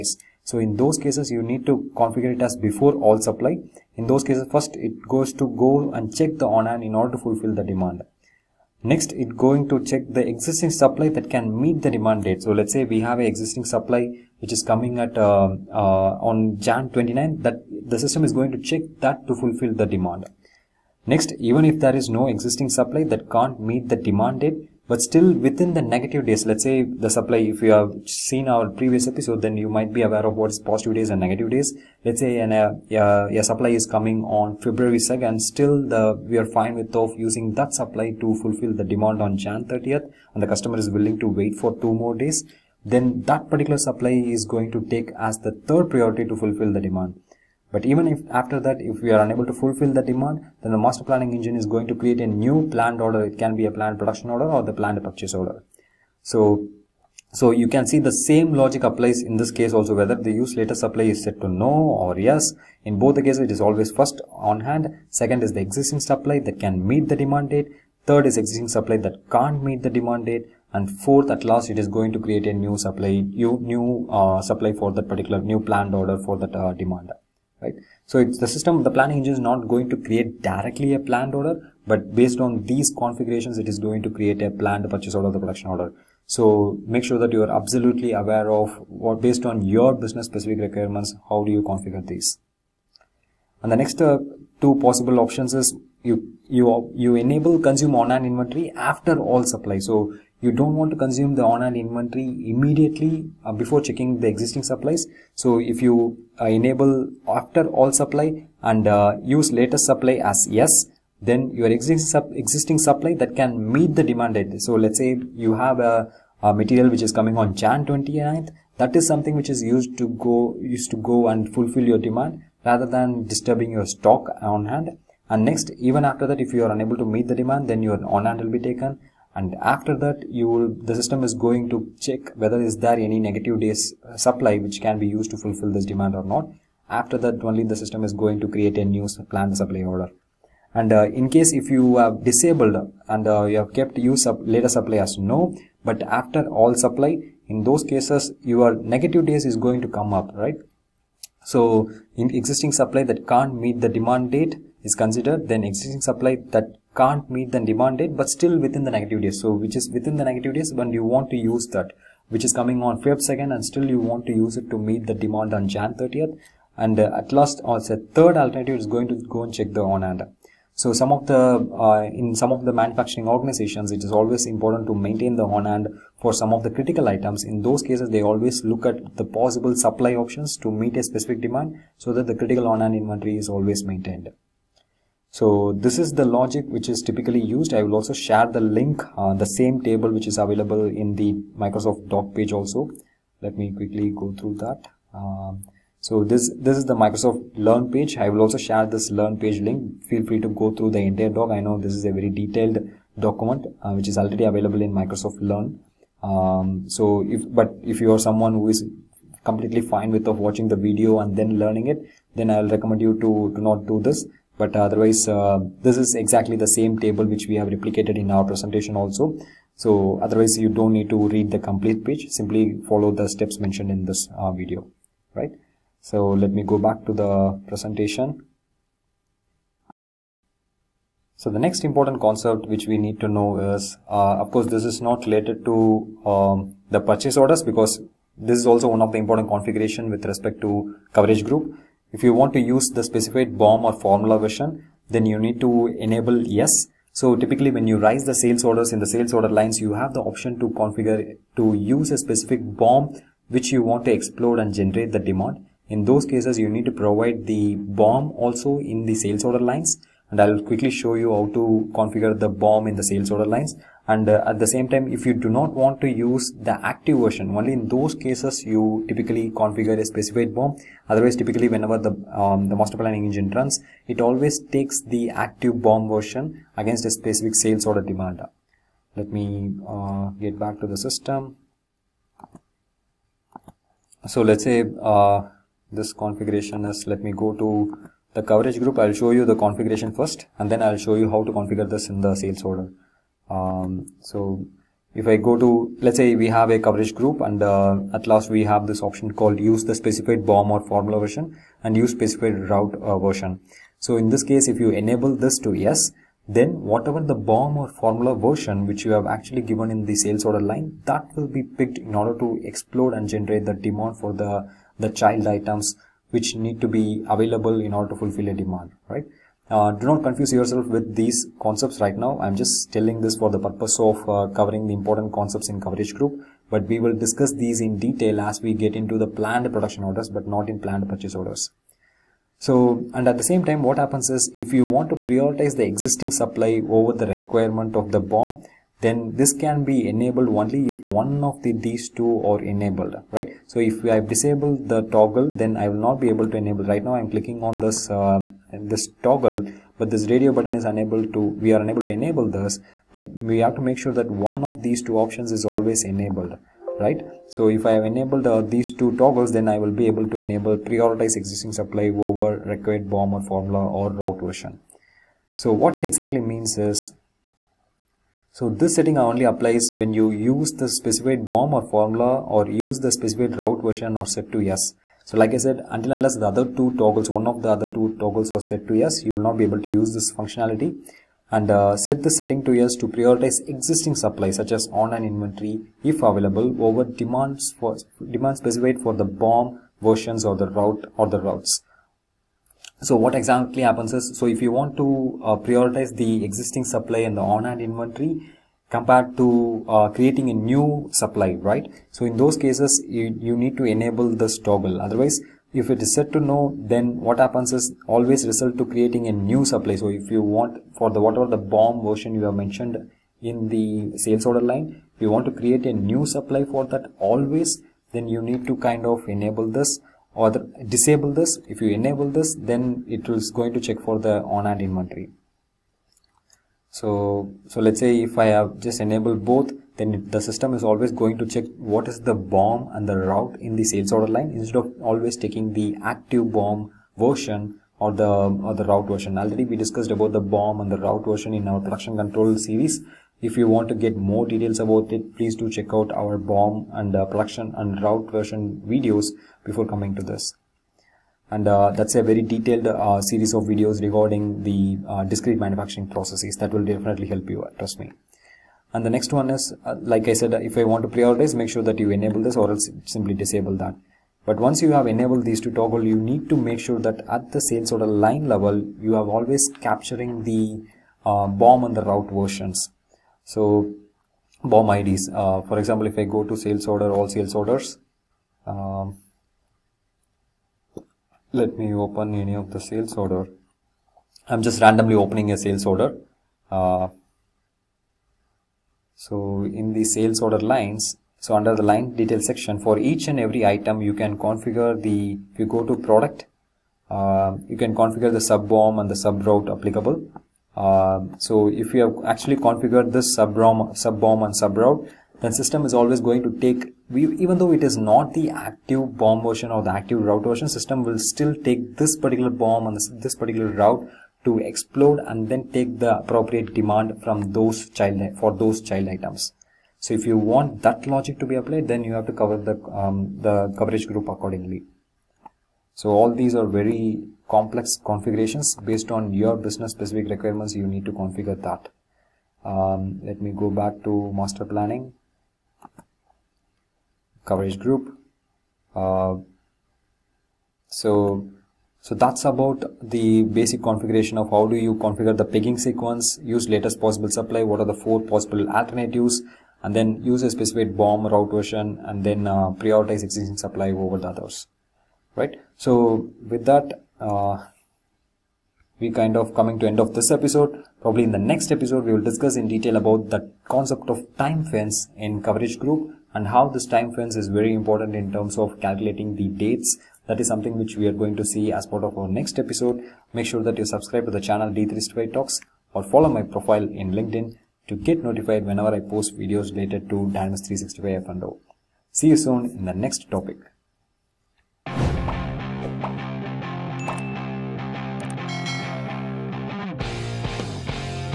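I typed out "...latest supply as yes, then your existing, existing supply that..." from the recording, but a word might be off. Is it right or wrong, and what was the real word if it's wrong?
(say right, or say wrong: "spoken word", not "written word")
right.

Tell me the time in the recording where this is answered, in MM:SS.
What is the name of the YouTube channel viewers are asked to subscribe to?
09:34.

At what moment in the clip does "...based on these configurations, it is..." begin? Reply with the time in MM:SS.
01:22.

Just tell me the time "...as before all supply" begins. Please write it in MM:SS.
00:02.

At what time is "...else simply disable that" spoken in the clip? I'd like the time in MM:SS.
07:42.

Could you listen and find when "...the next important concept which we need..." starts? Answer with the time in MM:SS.
03:51.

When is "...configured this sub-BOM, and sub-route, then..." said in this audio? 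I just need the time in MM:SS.
08:22.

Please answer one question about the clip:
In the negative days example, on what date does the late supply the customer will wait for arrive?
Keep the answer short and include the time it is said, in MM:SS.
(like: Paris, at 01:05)
February 2nd, at 00:34.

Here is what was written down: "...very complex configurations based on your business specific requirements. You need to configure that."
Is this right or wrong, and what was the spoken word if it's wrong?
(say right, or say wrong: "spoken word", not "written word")
right.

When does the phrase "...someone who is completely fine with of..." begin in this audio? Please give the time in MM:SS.
03:28.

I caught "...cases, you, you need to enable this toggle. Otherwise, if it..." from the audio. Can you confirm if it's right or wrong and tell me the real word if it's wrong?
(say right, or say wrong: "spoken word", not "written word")
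right.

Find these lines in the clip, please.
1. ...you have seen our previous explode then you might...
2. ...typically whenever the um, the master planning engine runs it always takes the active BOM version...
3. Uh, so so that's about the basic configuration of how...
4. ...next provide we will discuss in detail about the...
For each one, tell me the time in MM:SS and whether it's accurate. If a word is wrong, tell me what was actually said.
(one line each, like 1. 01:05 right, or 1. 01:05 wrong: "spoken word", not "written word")
1. 00:27 wrong: "episode", not "explode"
2. 04:31 right
3. 08:58 right
4. 09:21 wrong: "episode", not "provide".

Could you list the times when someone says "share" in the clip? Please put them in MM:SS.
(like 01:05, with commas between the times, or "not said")
03:08, 03:18.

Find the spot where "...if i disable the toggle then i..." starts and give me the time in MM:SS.
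05:43.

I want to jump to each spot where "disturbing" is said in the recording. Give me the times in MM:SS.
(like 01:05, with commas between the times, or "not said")
02:03.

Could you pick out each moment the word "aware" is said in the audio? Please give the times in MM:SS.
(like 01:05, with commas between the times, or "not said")
00:30, 01:28.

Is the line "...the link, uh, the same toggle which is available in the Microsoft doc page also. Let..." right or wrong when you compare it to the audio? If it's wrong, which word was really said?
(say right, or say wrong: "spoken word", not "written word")
wrong: "table", not "toggle".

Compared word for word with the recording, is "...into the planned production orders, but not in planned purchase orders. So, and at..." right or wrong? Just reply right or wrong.
right.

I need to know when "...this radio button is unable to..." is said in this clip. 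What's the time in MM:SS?
05:50.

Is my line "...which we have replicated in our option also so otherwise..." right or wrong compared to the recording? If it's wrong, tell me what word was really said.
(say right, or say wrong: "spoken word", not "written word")
wrong: "presentation", not "option".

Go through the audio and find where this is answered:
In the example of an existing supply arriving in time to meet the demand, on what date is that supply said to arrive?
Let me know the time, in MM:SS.
00:16.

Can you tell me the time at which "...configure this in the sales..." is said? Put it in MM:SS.
04:51.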